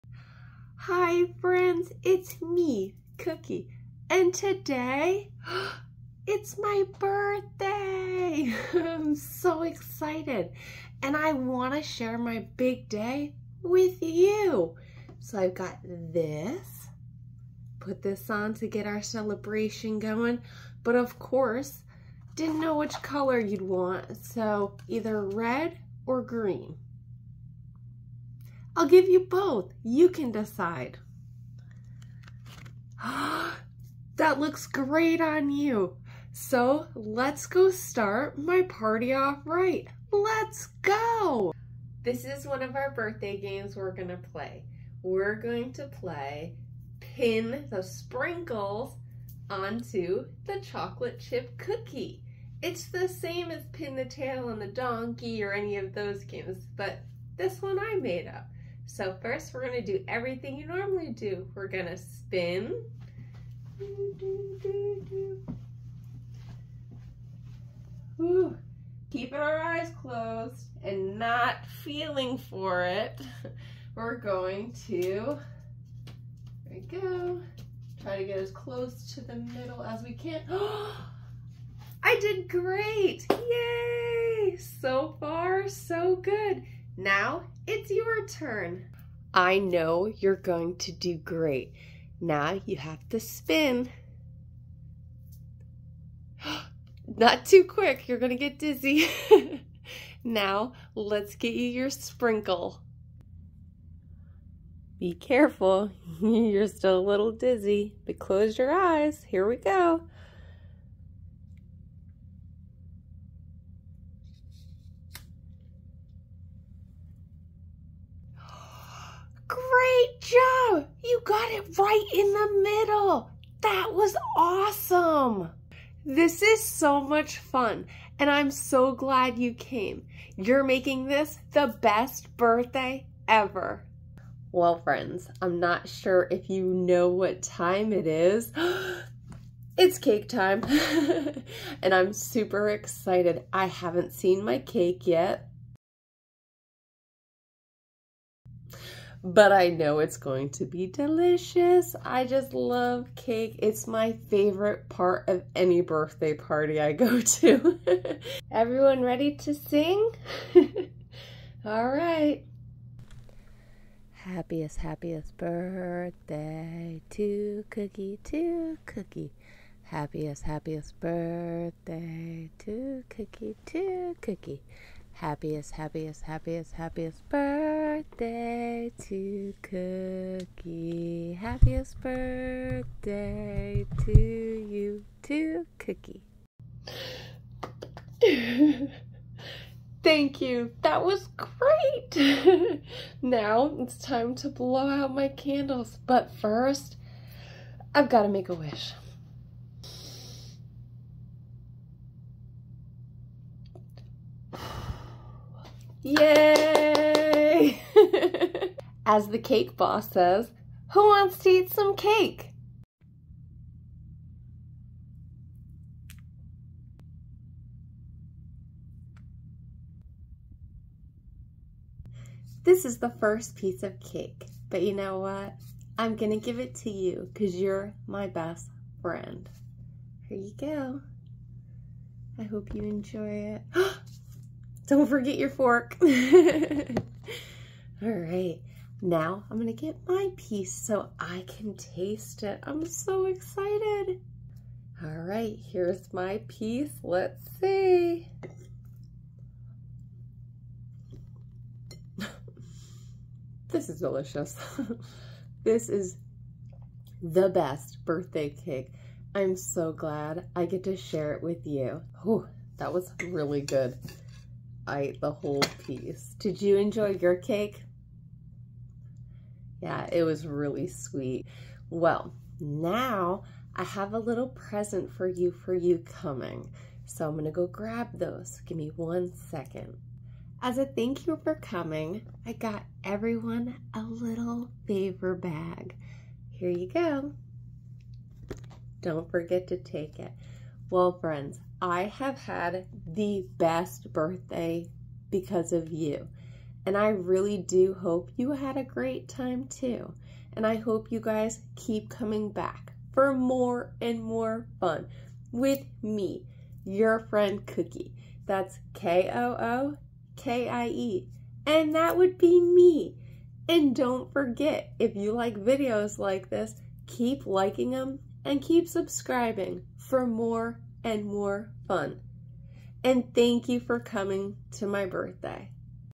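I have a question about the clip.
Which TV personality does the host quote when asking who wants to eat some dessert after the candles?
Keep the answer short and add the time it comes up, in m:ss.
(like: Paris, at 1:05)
the cake boss, at 3:29.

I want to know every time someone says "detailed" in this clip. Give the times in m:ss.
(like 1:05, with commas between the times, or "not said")
not said.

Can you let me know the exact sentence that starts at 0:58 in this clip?
So first we're gonna do everything you normally do.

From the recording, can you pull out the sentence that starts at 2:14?
Well, friends, I'm not sure if you know what time it is.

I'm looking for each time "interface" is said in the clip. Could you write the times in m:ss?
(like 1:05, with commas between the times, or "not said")
not said.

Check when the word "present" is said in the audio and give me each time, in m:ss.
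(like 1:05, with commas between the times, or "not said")
4:34.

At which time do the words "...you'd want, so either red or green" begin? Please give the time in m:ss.
0:23.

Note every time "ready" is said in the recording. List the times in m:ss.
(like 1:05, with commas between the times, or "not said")
2:39.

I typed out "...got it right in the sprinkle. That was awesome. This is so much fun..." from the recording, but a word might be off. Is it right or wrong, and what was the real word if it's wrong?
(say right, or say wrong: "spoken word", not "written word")
wrong: "middle", not "sprinkle".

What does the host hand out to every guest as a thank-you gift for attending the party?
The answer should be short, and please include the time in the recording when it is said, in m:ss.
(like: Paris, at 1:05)
favor bag, at 4:44.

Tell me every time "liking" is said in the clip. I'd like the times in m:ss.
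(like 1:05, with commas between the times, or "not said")
5:17.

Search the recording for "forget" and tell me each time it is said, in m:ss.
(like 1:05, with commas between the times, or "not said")
3:55, 4:49, 5:14.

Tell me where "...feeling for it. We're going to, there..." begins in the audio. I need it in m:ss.
1:11.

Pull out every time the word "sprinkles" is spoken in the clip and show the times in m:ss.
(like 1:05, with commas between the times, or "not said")
0:47, 1:41.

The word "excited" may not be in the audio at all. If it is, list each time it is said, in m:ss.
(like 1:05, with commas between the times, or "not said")
0:09, 2:22, 4:03.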